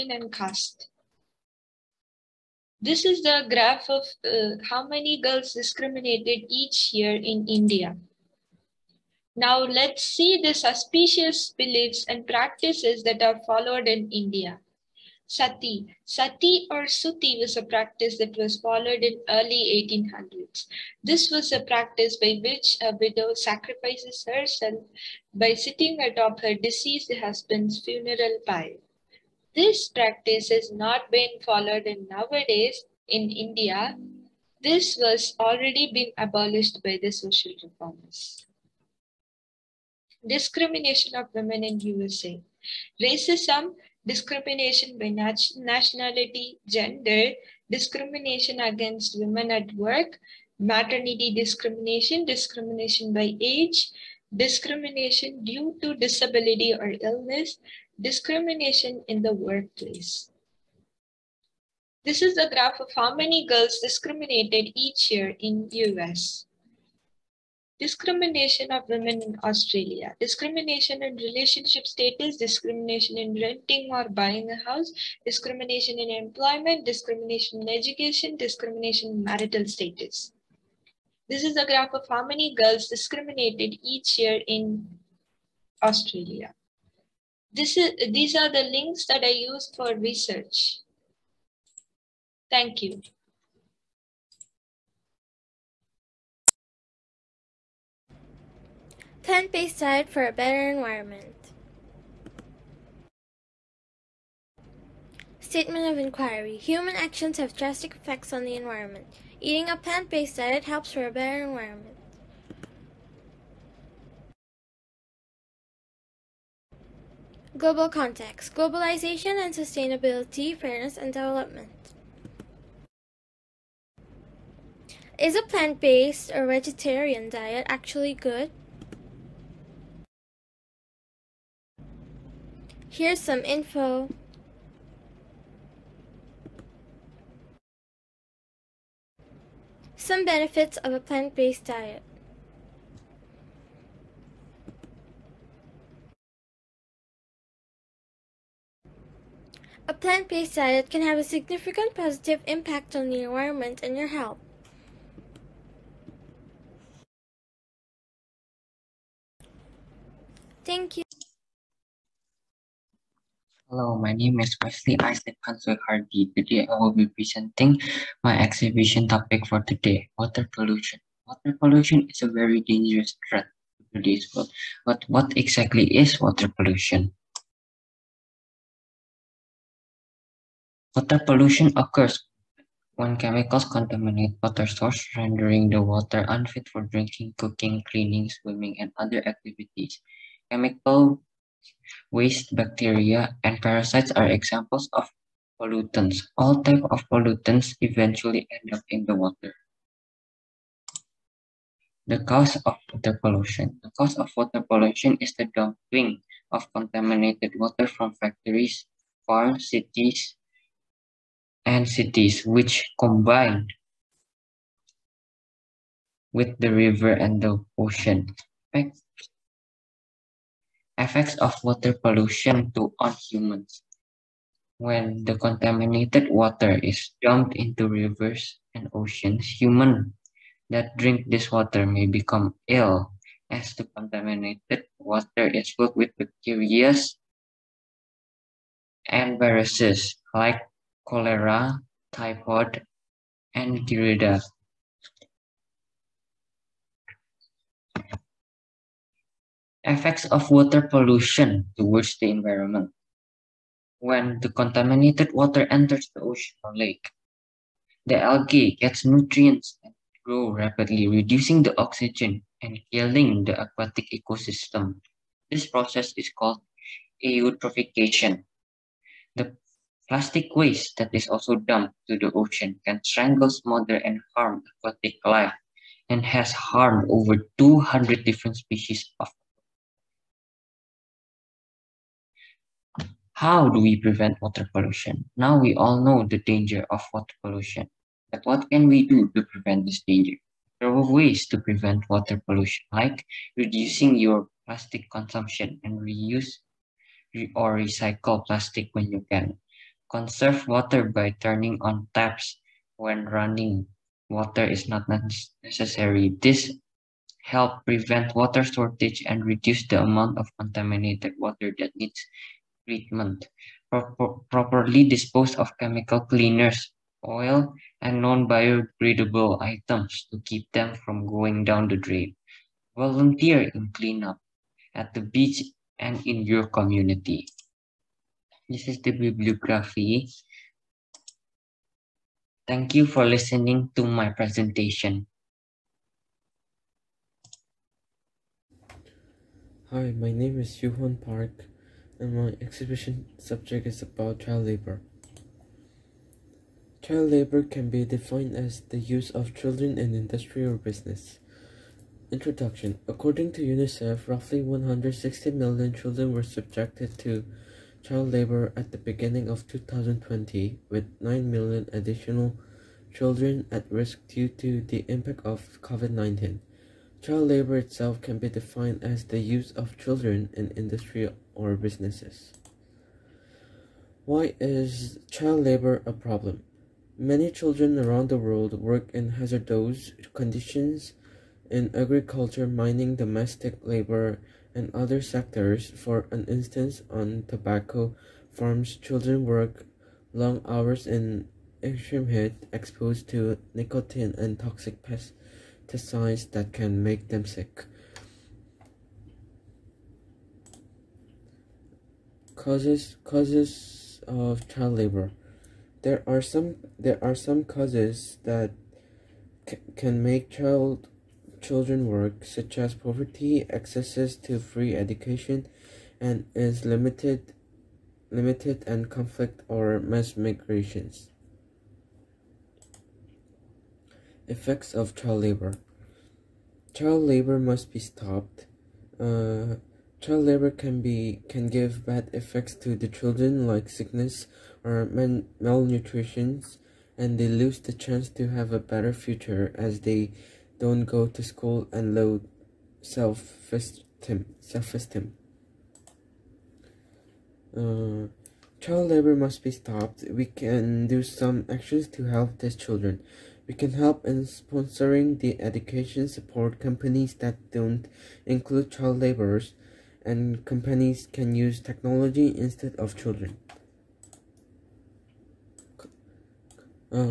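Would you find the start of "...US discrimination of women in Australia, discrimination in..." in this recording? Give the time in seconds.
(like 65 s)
65 s.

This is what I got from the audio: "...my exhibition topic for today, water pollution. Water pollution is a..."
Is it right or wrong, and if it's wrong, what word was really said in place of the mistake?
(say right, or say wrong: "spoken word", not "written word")
right.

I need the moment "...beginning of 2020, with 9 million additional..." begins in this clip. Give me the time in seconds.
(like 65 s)
358 s.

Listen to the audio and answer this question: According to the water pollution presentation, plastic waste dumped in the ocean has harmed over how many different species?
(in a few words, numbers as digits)
200.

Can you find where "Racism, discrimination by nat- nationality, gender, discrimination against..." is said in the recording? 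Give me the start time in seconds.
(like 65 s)
43 s.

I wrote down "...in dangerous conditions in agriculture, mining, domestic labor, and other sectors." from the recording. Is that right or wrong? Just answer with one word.
wrong.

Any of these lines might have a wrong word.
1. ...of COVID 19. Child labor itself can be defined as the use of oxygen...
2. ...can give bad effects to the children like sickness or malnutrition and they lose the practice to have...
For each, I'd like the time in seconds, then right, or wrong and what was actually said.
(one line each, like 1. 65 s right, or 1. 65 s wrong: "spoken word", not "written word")
1. 365 s wrong: "children", not "oxygen"
2. 431 s wrong: "chance", not "practice".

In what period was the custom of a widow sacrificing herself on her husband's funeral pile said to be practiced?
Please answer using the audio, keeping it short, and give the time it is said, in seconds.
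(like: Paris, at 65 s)
early 1800s, at 19 s.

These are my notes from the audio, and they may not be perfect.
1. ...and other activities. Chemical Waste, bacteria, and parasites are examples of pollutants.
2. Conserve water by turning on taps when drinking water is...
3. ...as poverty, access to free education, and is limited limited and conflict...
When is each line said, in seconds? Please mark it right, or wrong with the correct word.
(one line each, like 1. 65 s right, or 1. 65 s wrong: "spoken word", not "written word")
1. 188 s right
2. 300 s wrong: "running", not "drinking"
3. 412 s right.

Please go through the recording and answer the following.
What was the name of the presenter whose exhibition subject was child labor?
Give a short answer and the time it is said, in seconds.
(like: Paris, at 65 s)
Yuhan Park, at 340 s.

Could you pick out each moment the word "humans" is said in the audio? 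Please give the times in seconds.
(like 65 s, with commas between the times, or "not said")
106 s, 223 s, 229 s.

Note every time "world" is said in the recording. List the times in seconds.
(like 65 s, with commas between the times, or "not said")
174 s, 378 s.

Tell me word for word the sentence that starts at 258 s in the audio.
The algae gets nutrients and grow rapidly, reducing the oxygen and killing the aquatic ecosystem.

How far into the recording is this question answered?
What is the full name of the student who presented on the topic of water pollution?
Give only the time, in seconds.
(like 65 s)
164 s.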